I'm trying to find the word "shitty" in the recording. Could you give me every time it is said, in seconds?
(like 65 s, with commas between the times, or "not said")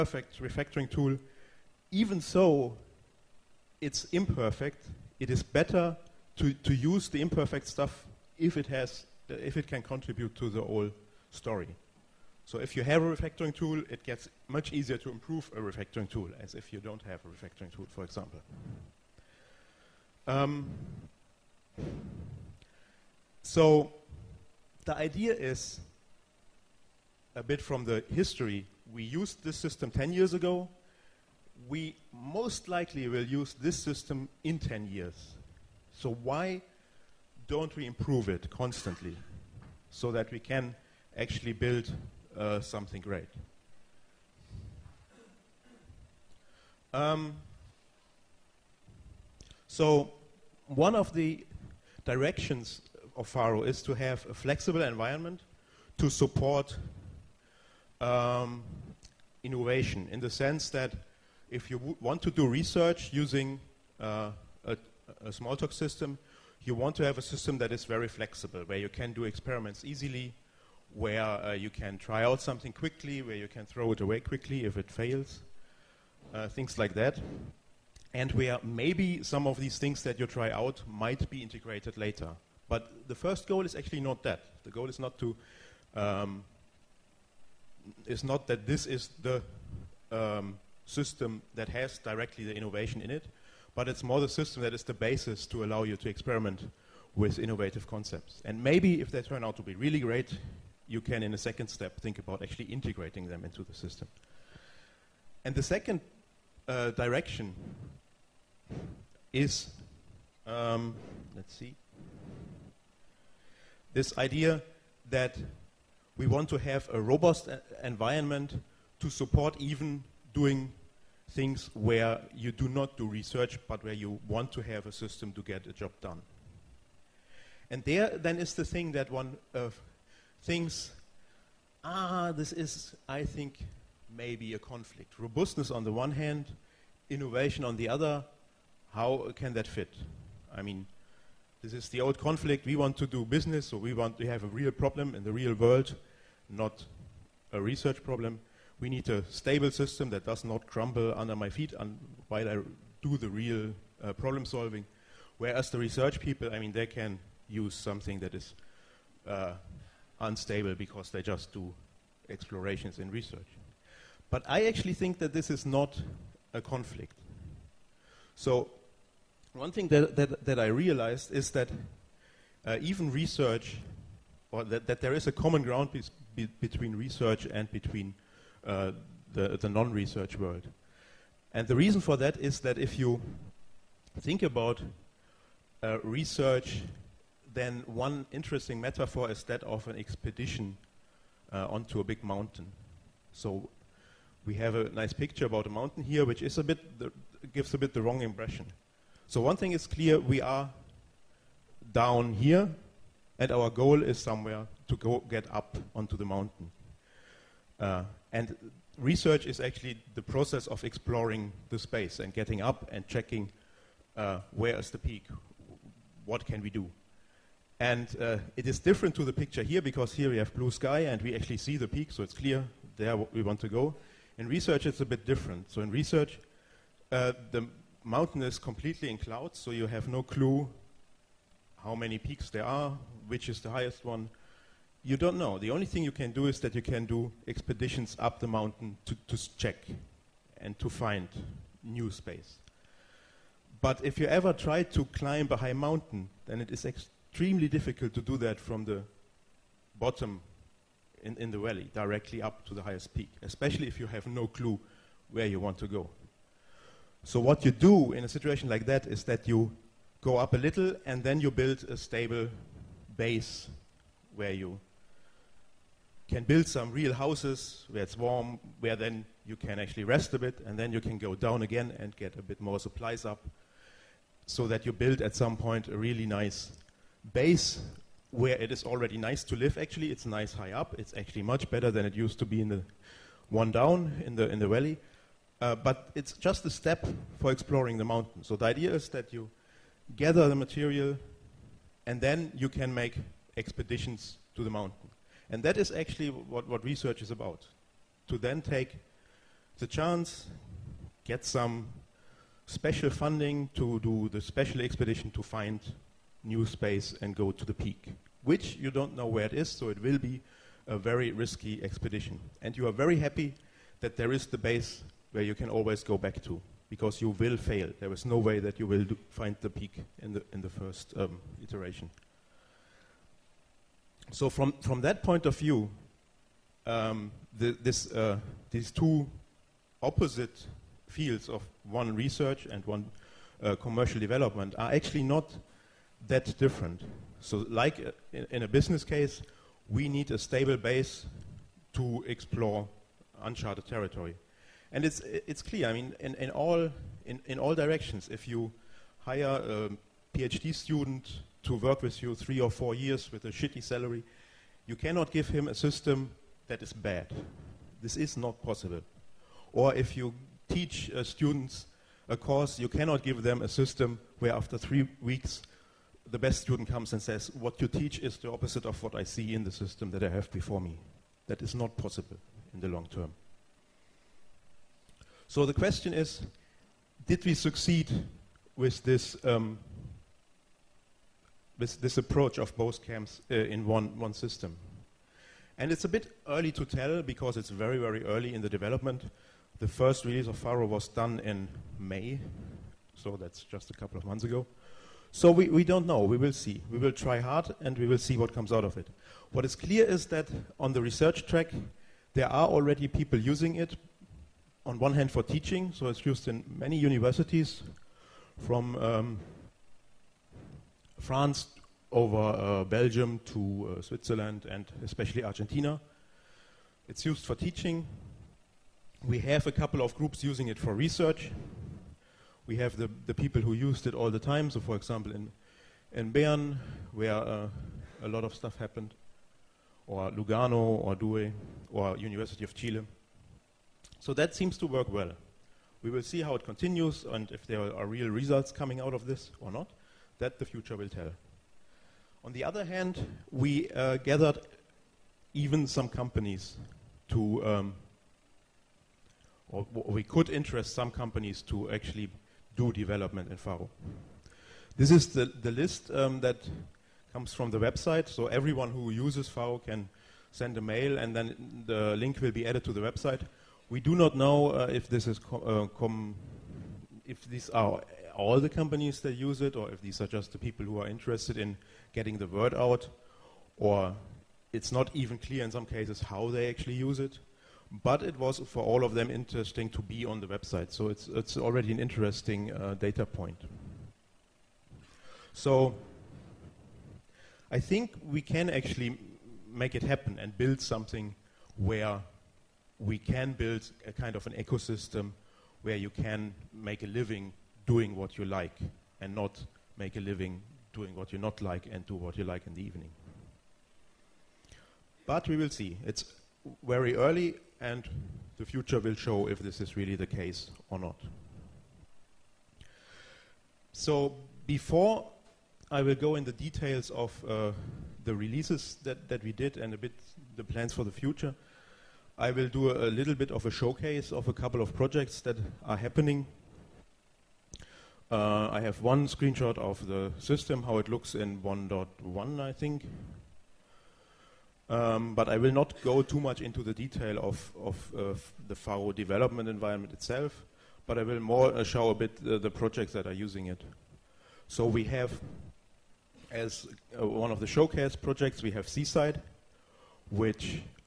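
353 s.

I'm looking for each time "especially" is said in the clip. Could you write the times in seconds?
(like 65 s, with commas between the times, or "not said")
253 s, 415 s.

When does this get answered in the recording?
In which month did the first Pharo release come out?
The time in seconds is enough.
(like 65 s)
391 s.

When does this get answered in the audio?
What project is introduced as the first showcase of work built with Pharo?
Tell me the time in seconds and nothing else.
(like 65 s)
548 s.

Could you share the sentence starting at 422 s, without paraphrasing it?
We have the, the people who used it all the time.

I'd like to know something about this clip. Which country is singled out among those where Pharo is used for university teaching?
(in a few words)
Argentina.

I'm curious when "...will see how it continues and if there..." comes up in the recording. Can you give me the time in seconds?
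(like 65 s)
436 s.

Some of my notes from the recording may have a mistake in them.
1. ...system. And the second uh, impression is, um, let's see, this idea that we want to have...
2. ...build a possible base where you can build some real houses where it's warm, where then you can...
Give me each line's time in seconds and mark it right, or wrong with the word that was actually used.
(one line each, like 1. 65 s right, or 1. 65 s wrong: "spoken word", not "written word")
1. 103 s wrong: "direction", not "impression"
2. 261 s wrong: "stable", not "possible".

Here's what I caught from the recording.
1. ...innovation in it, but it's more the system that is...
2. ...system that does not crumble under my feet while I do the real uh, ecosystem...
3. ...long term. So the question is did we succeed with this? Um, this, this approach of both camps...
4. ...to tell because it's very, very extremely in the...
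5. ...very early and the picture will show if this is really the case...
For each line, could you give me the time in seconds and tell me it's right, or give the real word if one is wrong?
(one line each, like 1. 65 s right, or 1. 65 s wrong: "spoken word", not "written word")
1. 92 s right
2. 149 s wrong: "problem", not "ecosystem"
3. 372 s right
4. 386 s wrong: "early", not "extremely"
5. 506 s wrong: "future", not "picture".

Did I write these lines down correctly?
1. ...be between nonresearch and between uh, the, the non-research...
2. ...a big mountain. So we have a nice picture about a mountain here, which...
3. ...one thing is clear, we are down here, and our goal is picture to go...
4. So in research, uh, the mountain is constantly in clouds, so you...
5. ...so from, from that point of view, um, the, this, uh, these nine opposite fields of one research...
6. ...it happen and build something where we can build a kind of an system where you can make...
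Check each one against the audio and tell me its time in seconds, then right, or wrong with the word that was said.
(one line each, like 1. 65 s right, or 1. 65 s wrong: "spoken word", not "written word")
1. 176 s wrong: "research", not "nonresearch"
2. 192 s right
3. 199 s wrong: "somewhere", not "picture"
4. 225 s wrong: "completely", not "constantly"
5. 324 s wrong: "two", not "nine"
6. 489 s wrong: "ecosystem", not "system".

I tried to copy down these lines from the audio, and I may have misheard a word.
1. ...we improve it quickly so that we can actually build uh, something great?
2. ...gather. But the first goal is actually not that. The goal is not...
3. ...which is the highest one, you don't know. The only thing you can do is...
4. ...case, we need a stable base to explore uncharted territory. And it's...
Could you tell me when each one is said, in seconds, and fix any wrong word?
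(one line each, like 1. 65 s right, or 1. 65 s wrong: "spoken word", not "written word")
1. 37 s wrong: "constantly", not "quickly"
2. 81 s wrong: "later", not "gather"
3. 233 s right
4. 339 s right.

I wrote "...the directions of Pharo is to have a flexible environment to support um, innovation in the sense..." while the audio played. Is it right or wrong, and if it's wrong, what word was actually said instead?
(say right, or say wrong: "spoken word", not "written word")
right.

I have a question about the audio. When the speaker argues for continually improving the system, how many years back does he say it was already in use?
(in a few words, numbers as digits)
10.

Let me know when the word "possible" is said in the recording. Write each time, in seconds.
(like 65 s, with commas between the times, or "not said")
358 s, 371 s.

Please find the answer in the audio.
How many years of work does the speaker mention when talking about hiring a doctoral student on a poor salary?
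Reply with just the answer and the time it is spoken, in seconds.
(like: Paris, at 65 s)
Three or four, at 352 s.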